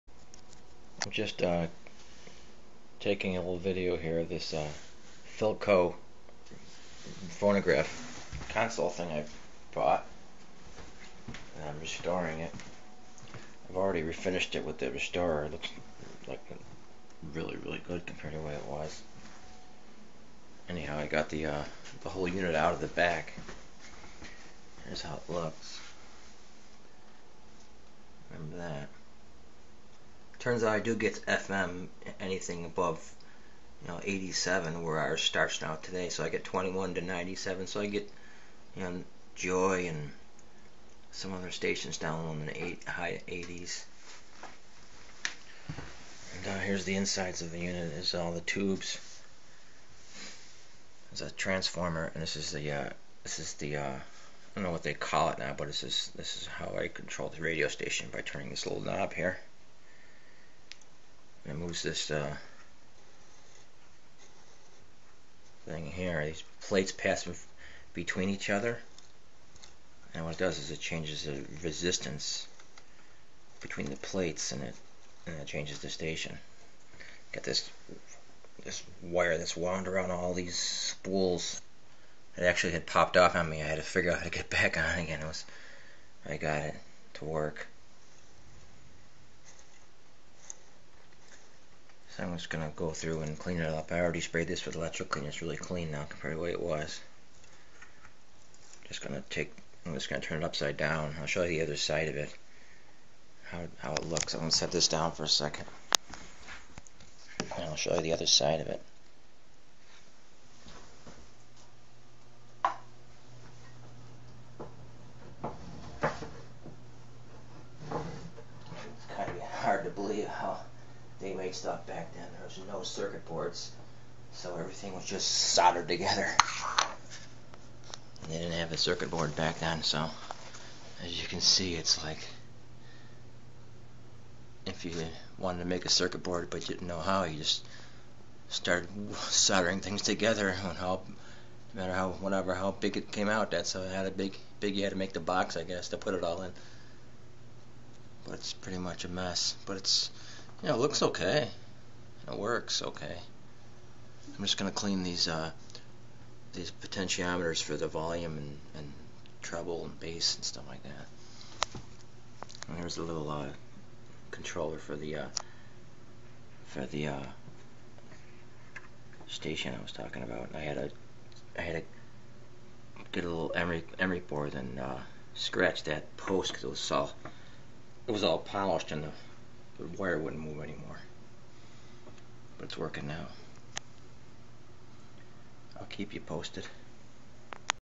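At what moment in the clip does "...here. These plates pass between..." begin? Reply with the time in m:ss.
1:05.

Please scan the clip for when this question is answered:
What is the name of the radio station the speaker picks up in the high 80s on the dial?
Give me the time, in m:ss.
0:39.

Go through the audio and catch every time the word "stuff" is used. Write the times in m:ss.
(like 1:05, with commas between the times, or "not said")
2:01, 2:40.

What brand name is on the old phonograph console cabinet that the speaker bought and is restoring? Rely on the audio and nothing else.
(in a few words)
Philco.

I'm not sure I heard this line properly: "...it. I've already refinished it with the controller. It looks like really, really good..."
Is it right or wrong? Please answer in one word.
wrong.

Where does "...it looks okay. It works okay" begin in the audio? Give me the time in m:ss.
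2:30.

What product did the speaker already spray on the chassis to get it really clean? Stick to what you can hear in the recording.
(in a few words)
electrical cleaner.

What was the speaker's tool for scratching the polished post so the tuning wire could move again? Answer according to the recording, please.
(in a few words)
emery board.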